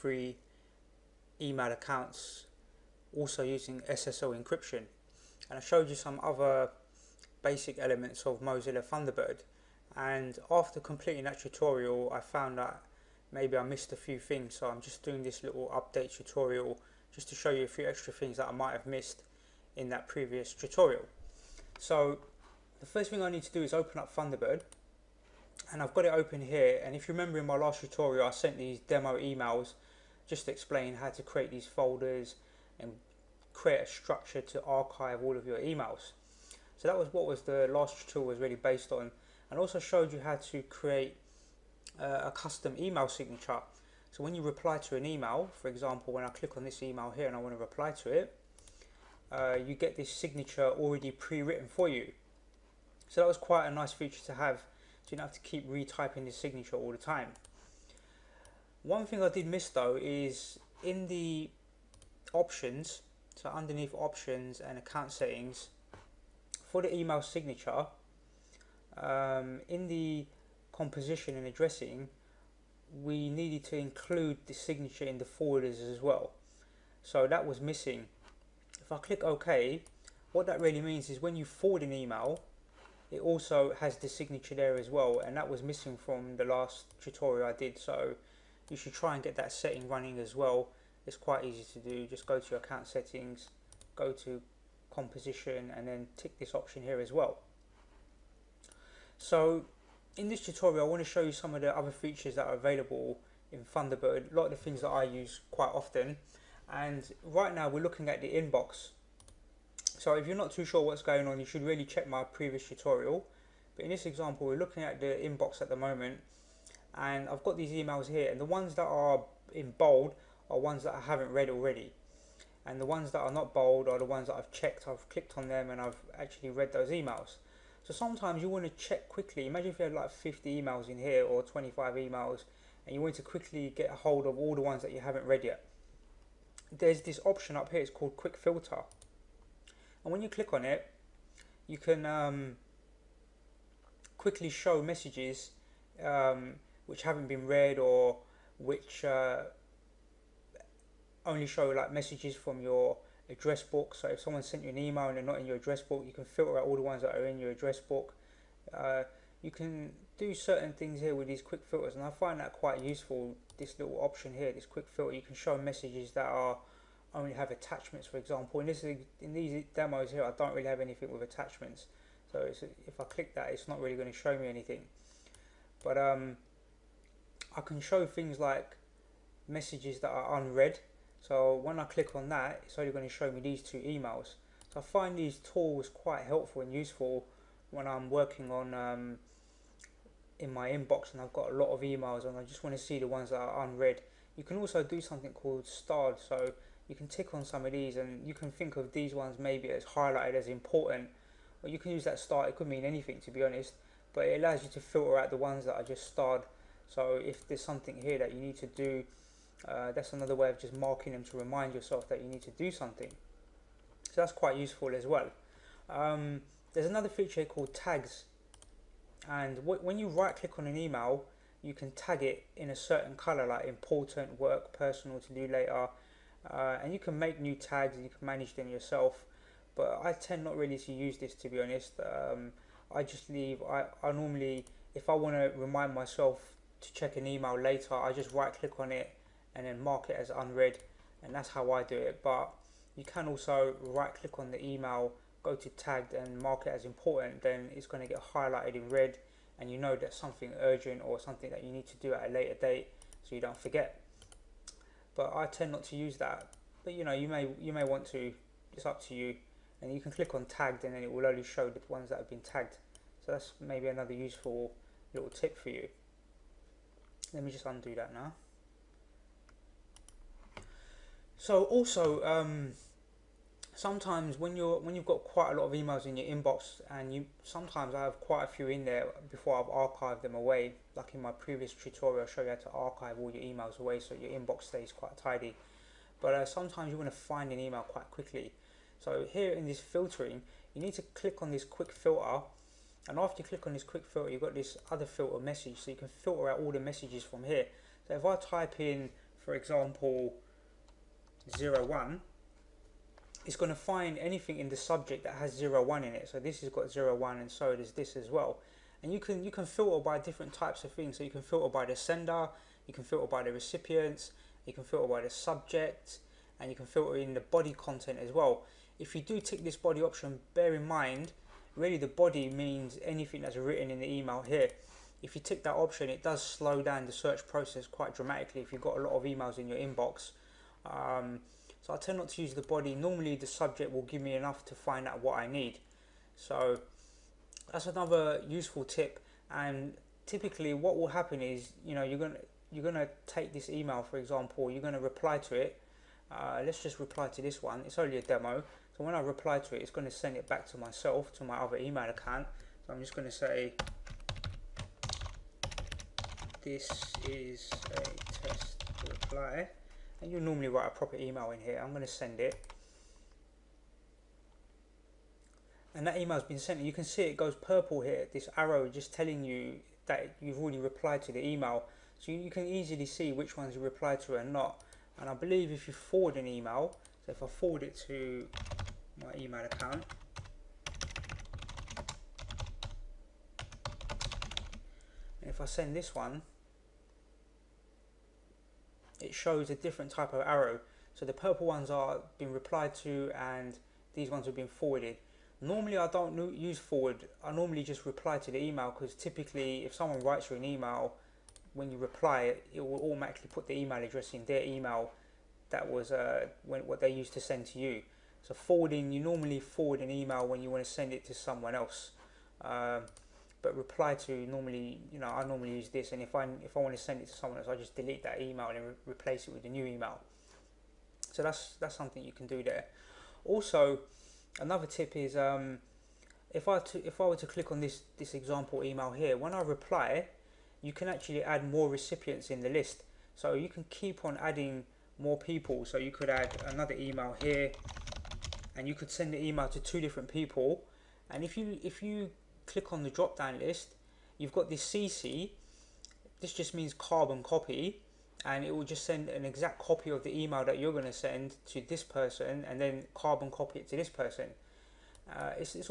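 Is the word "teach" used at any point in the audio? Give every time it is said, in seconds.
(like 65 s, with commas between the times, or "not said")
not said.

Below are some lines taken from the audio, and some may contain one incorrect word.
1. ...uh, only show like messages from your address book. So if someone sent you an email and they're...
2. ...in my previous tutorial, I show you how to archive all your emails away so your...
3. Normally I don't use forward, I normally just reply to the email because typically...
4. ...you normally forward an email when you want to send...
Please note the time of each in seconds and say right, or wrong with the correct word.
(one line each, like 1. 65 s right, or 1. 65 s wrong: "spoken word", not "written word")
1. 149 s right
2. 281 s right
3. 395 s right
4. 409 s right.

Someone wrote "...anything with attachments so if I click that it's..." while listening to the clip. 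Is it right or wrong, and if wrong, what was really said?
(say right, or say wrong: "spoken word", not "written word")
right.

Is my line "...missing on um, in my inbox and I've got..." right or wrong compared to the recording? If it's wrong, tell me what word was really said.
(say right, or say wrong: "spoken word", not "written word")
wrong: "working", not "missing".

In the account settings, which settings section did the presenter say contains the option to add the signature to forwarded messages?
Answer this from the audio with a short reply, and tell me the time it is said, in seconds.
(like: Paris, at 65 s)
Composition and addressing, at 70 s.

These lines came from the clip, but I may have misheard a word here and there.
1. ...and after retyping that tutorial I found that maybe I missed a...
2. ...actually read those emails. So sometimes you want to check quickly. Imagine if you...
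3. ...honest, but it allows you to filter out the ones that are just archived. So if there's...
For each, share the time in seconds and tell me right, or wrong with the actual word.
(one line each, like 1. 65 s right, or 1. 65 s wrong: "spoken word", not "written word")
1. 9 s wrong: "completing", not "retyping"
2. 126 s right
3. 203 s wrong: "starred", not "archived".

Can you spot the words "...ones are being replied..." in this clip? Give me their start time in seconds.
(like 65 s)
391 s.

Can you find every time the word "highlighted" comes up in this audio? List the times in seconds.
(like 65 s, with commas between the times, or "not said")
199 s, 248 s.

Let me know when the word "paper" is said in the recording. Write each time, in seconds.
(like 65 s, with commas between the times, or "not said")
not said.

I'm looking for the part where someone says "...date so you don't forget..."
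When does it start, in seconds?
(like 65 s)
252 s.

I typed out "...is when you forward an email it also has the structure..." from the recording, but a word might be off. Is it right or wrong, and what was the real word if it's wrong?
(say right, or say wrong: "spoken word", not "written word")
wrong: "signature", not "structure".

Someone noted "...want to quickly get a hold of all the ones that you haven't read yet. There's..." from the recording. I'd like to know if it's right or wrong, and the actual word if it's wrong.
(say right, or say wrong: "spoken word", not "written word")
right.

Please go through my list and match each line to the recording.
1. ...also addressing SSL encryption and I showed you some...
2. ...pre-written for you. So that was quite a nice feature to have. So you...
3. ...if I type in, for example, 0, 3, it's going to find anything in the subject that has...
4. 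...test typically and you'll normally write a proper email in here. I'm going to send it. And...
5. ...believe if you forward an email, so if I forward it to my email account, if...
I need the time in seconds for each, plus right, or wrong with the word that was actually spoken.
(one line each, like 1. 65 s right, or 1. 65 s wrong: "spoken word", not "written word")
1. 3 s wrong: "using", not "addressing"
2. 51 s right
3. 298 s wrong: "1", not "3"
4. 358 s wrong: "reply", not "typically"
5. 375 s right.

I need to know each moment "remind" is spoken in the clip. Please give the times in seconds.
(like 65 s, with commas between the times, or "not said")
211 s, 235 s.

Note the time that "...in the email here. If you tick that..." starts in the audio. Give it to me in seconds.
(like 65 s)
323 s.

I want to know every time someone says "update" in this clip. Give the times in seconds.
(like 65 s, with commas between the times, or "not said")
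15 s.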